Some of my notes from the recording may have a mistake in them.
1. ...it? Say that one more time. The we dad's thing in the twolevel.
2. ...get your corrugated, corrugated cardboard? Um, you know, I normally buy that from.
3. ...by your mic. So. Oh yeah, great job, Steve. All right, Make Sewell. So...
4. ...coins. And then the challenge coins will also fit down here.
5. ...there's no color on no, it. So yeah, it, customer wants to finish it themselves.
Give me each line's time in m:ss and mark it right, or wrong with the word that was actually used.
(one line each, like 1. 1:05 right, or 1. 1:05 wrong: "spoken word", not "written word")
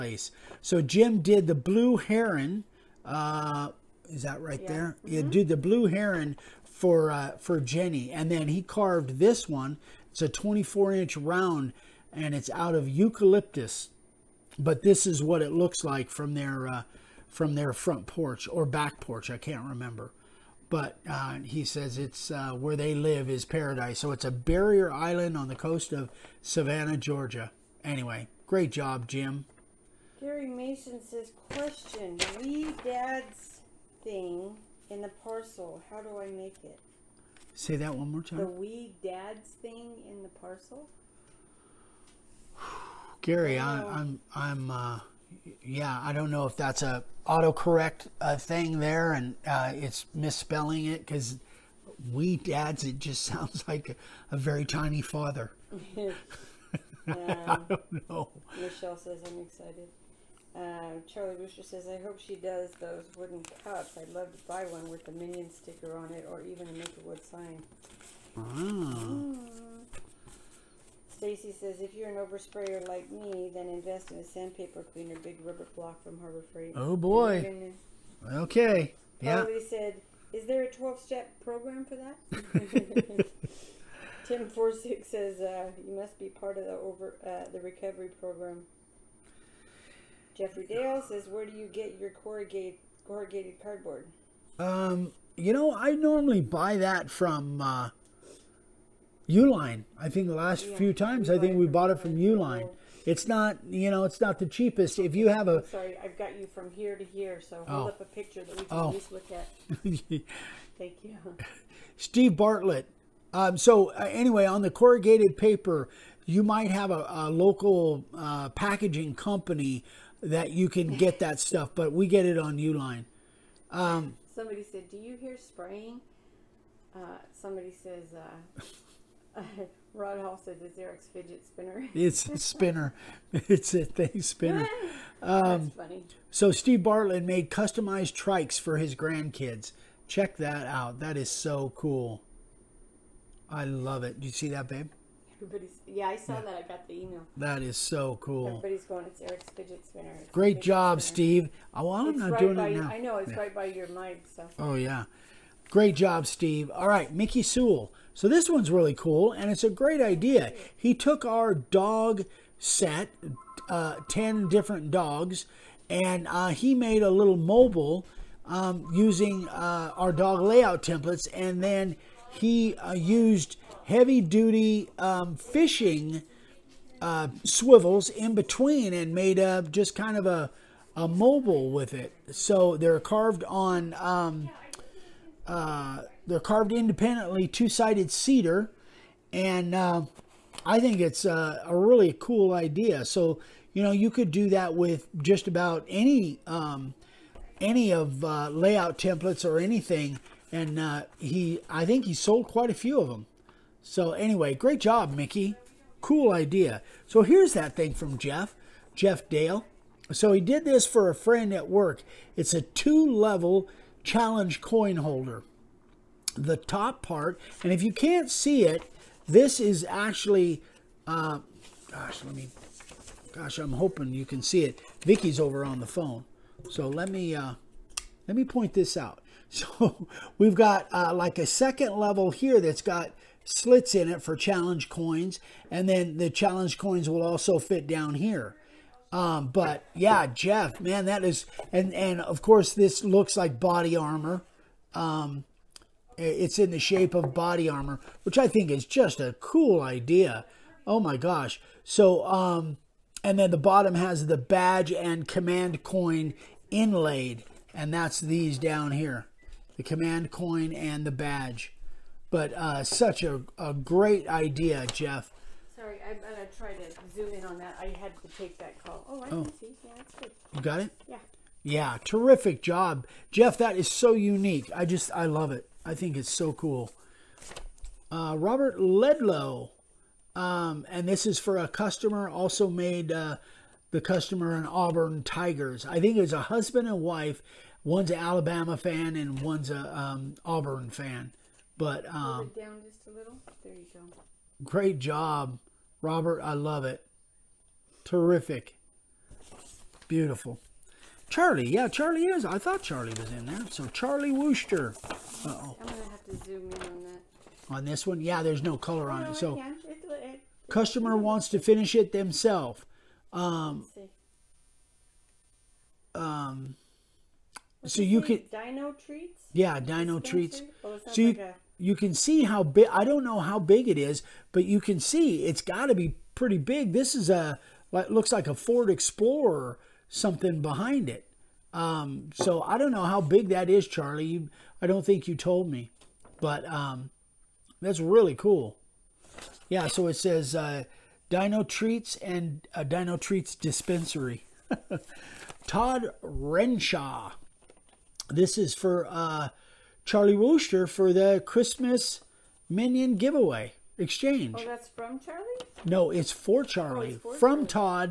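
1. 0:36 wrong: "parcel", not "twolevel"
2. 1:31 right
3. 2:33 wrong: "Mickey", not "Make"
4. 3:54 right
5. 5:08 right.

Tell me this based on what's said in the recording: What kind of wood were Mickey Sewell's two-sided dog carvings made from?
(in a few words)
cedar.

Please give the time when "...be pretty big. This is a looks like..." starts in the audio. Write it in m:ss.
5:25.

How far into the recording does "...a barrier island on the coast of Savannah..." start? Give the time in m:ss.
0:24.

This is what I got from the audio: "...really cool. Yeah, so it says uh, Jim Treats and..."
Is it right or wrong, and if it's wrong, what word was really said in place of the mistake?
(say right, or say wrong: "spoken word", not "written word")
wrong: "Dino", not "Jim".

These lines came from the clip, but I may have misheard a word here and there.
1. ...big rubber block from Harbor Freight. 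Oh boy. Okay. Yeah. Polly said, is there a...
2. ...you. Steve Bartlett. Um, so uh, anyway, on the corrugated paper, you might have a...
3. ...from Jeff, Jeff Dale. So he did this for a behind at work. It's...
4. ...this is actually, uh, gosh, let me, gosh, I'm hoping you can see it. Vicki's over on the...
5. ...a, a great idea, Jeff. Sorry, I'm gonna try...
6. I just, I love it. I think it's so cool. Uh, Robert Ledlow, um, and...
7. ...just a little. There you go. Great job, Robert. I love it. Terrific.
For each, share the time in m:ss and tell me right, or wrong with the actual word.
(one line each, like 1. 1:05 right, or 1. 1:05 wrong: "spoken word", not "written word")
1. 1:15 right
2. 1:51 right
3. 3:27 wrong: "friend", not "behind"
4. 3:39 right
5. 4:23 right
6. 4:34 right
7. 4:52 right.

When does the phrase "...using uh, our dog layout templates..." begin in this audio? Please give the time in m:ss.
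2:48.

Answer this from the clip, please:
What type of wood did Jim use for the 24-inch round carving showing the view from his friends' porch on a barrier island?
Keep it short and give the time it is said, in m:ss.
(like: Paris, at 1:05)
eucalyptus, at 0:12.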